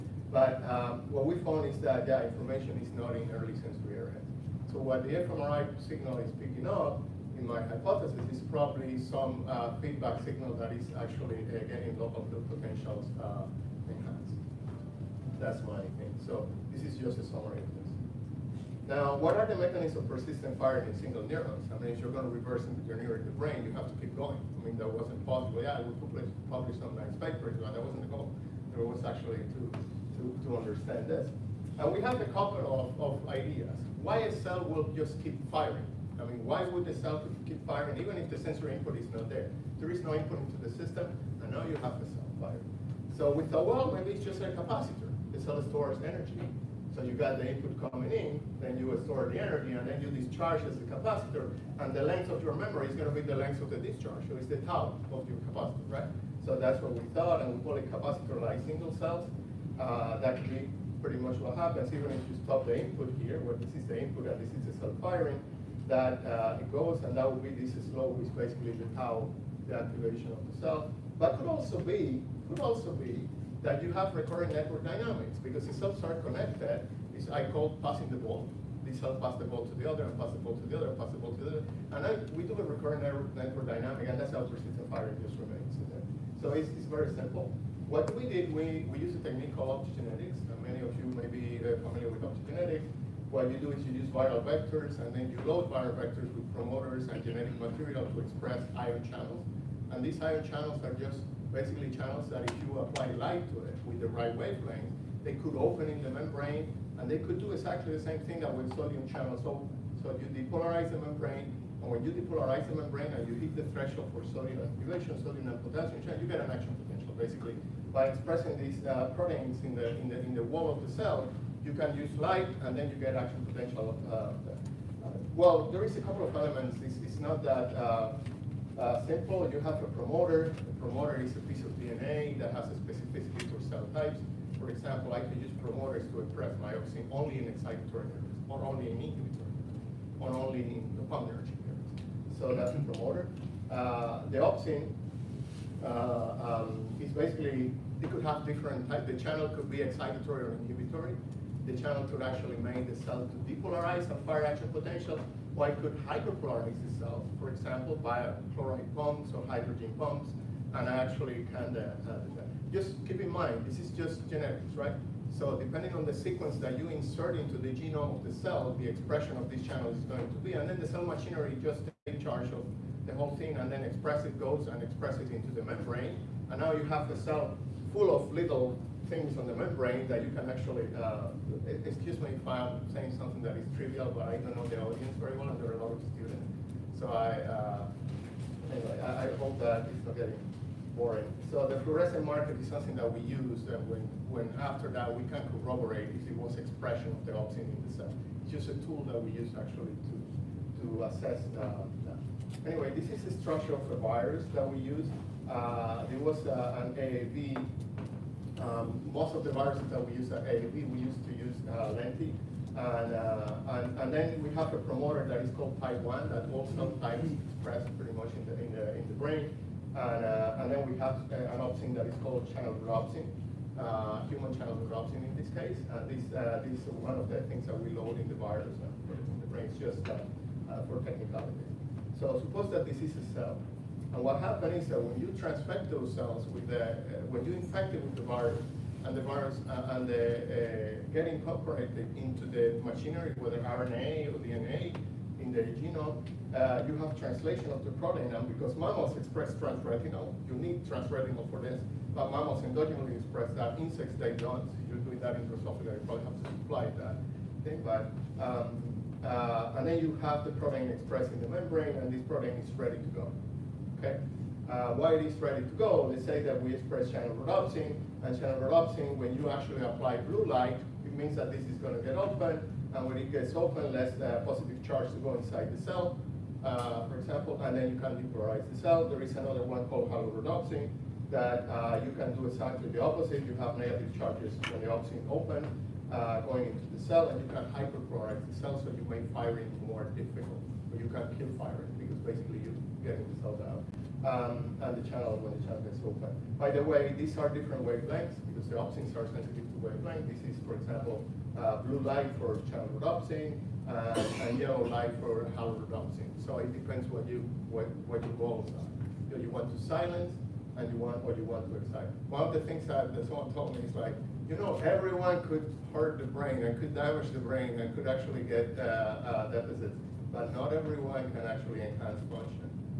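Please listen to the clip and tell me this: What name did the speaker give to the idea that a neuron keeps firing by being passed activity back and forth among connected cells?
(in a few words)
Passing the ball.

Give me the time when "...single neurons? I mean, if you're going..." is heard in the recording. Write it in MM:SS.
00:20.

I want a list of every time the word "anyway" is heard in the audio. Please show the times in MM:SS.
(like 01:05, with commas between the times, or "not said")
03:08, 03:22.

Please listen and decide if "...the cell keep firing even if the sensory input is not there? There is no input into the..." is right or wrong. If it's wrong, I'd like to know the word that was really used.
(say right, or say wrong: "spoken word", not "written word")
right.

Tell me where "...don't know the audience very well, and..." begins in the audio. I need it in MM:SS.
03:04.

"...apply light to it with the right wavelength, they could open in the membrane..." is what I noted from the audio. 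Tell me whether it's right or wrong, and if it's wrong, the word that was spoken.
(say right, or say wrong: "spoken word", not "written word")
right.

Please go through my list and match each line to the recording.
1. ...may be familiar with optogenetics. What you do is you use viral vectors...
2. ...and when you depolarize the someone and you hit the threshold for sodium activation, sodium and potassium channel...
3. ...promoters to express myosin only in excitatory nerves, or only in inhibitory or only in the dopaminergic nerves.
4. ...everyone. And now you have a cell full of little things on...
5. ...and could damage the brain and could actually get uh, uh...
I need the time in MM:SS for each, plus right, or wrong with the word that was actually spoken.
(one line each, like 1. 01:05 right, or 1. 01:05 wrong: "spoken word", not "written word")
1. 01:31 right
2. 01:51 wrong: "membrane", not "someone"
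3. 02:15 right
4. 02:55 wrong: "membrane", not "everyone"
5. 05:16 right.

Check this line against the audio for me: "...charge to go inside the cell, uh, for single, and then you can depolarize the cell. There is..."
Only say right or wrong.
wrong.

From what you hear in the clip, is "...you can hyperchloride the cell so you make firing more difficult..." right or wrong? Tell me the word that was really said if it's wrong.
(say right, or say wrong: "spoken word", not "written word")
right.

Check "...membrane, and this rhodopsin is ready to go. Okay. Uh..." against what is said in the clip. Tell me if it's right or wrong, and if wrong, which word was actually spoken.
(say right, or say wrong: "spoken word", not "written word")
wrong: "protein", not "rhodopsin".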